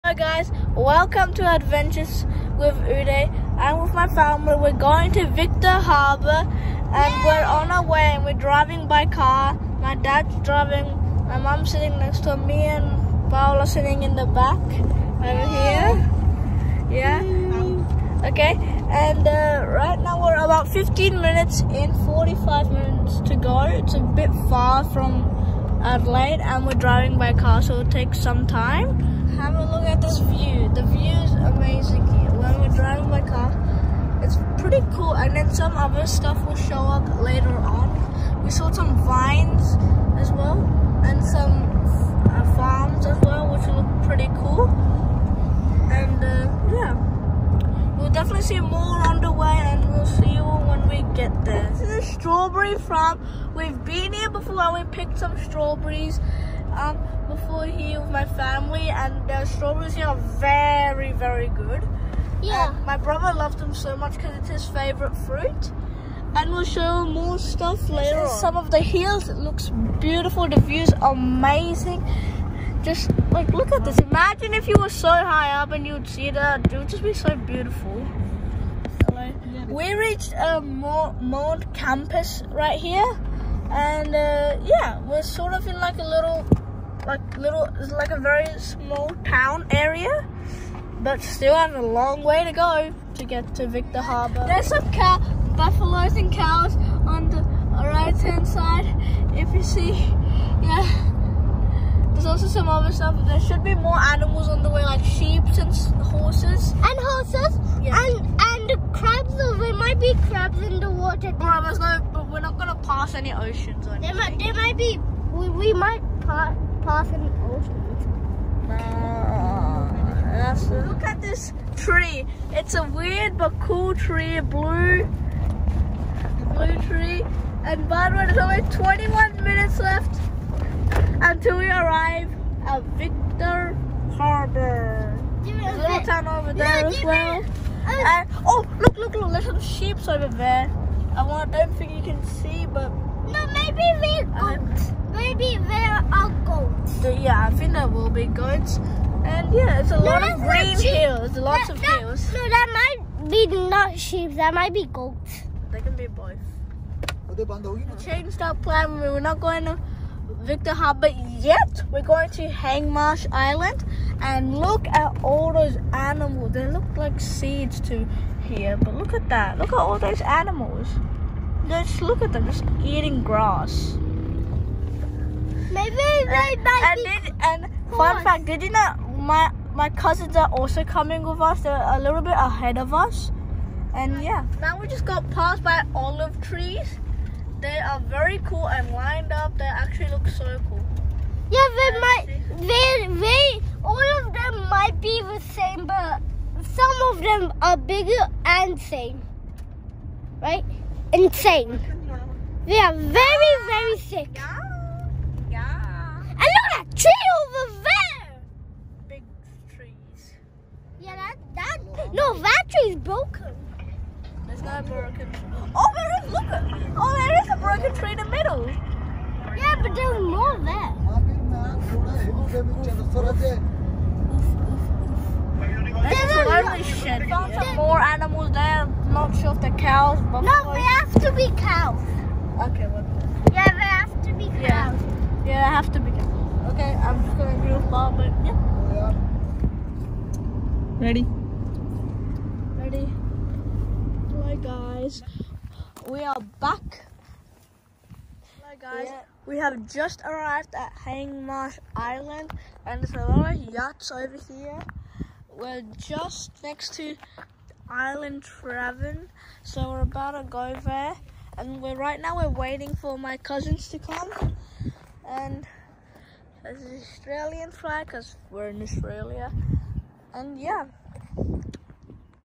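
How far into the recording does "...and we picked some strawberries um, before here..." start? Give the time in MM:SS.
00:54.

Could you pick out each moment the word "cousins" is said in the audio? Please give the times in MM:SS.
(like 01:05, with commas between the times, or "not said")
02:59, 04:23.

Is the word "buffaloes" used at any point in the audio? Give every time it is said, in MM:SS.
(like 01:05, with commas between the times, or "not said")
01:35.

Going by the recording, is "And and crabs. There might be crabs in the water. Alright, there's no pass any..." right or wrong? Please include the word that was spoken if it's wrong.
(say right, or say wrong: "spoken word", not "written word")
right.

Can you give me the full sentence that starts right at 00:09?
My dad's driving, my mom's sitting next to me and Paola sitting in the back over here.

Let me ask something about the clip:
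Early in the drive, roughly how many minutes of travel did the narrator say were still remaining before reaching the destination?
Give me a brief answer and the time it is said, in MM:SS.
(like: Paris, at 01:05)
45 minutes, at 00:22.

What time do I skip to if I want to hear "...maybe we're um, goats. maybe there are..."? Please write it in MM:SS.
02:23.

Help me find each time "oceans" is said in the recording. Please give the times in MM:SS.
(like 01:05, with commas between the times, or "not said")
01:53, 01:57.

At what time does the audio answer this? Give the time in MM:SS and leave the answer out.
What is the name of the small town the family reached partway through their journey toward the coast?
01:20.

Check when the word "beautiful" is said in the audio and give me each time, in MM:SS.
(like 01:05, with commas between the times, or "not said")
01:09, 01:17.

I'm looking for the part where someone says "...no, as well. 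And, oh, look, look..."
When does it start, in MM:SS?
02:16.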